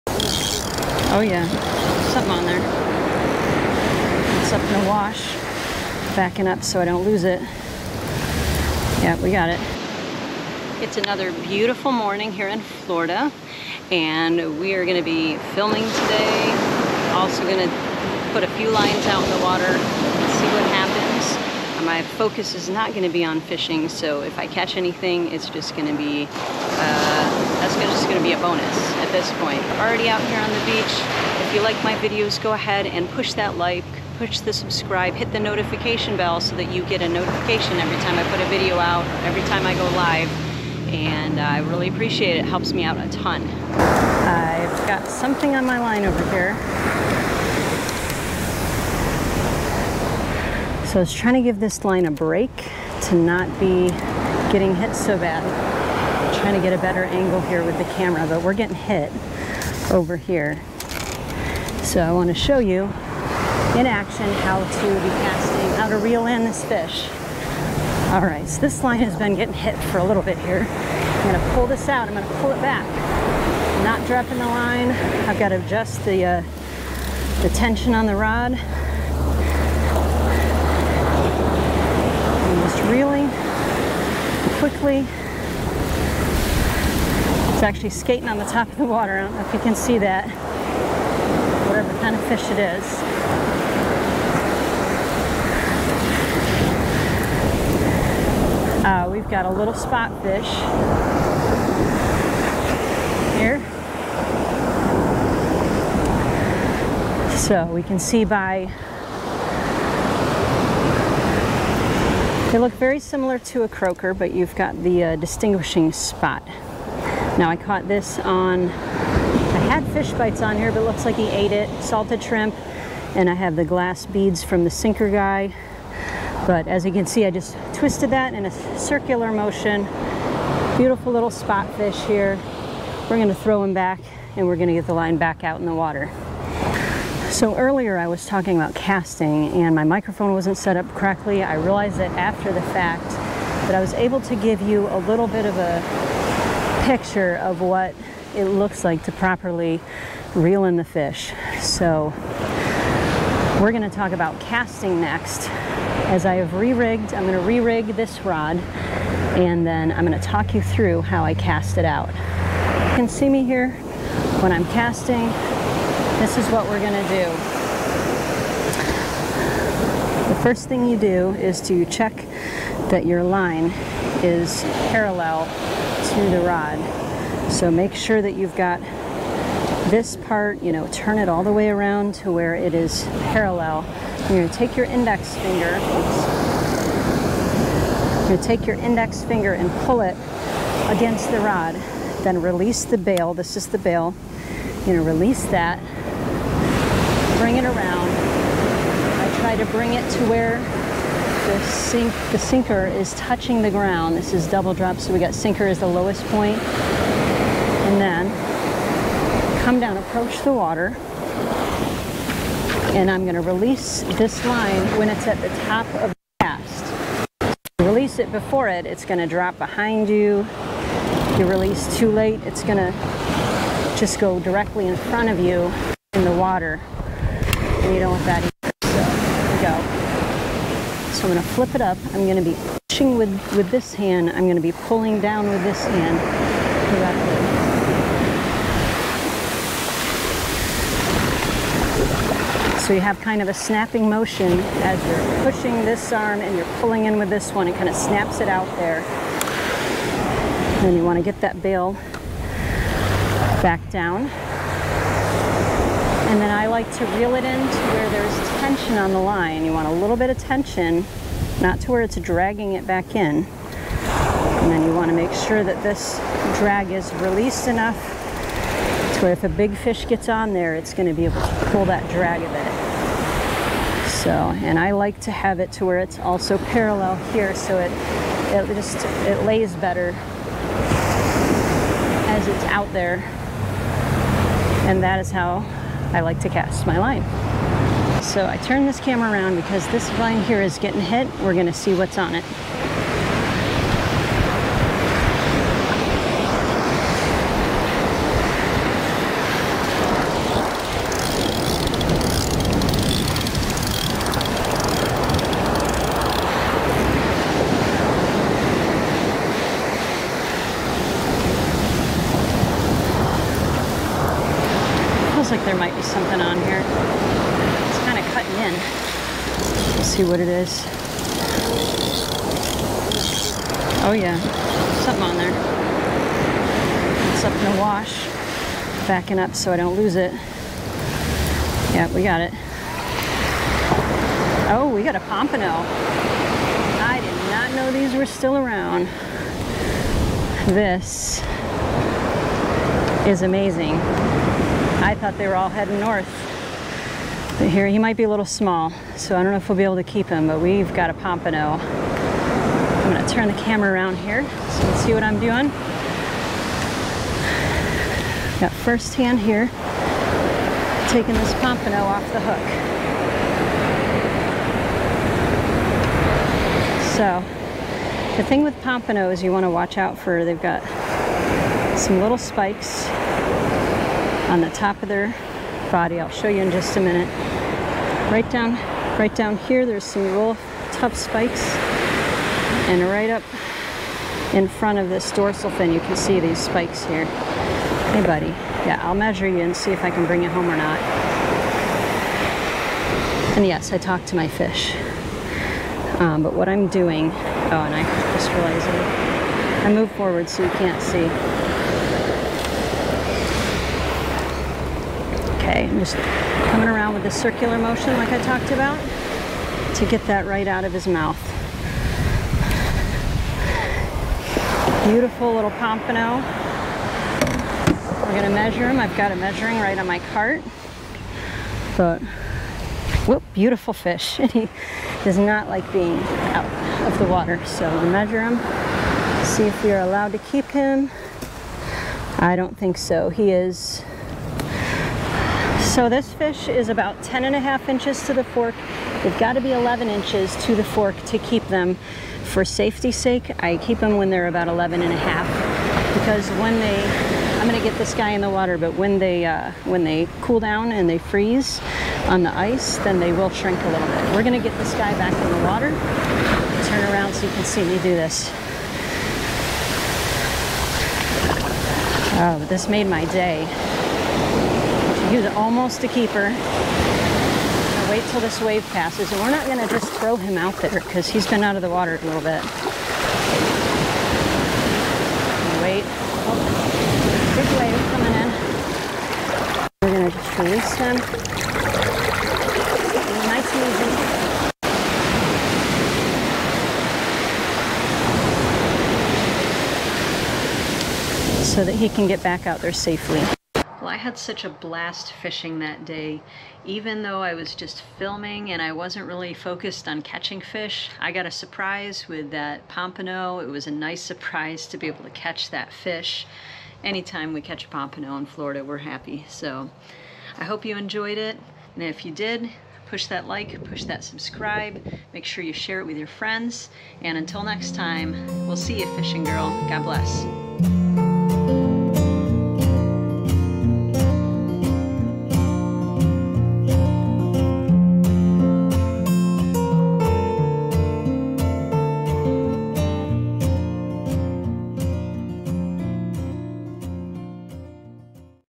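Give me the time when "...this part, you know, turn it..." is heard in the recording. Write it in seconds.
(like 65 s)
179 s.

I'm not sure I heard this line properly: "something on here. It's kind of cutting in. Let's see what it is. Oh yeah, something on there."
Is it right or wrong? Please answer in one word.
right.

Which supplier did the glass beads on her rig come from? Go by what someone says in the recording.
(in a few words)
the sinker guy.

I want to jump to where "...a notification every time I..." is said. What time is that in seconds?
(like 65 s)
37 s.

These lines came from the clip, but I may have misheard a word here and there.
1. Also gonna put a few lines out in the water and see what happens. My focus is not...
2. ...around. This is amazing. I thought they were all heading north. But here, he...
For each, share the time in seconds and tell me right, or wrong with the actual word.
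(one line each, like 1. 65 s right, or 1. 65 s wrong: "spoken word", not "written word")
1. 17 s right
2. 338 s right.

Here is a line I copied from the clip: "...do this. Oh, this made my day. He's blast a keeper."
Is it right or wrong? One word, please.
wrong.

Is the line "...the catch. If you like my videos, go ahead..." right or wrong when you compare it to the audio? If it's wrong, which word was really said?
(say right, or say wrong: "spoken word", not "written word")
wrong: "beach", not "catch".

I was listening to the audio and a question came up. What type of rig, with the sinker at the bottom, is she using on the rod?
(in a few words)
double drop.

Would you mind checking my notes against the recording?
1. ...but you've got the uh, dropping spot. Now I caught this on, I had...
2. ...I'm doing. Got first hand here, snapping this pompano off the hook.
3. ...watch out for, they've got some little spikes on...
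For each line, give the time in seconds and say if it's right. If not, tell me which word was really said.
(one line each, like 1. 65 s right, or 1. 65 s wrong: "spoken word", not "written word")
1. 114 s wrong: "distinguishing", not "dropping"
2. 355 s wrong: "taking", not "snapping"
3. 369 s right.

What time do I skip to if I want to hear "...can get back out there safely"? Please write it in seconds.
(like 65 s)
492 s.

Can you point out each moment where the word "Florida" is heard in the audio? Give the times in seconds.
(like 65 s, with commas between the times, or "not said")
12 s, 508 s.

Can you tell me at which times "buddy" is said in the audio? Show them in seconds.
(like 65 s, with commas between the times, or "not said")
388 s.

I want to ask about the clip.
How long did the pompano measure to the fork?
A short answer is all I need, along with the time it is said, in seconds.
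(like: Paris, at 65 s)
10 and a half inches, at 437 s.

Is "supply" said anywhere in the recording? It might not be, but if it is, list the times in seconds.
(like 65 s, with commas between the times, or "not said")
not said.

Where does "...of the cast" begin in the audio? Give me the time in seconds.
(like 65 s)
215 s.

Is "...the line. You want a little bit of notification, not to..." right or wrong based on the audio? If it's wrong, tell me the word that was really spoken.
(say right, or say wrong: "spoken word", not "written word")
wrong: "tension", not "notification".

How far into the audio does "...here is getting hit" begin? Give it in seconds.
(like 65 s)
290 s.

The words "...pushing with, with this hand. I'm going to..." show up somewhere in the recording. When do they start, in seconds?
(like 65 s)
232 s.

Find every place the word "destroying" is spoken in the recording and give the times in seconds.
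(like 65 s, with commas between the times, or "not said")
not said.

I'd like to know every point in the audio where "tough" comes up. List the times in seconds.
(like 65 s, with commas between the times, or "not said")
380 s.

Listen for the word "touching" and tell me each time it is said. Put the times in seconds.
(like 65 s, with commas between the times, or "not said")
203 s.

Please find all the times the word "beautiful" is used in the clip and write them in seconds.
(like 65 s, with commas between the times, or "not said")
11 s, 130 s, 415 s, 423 s.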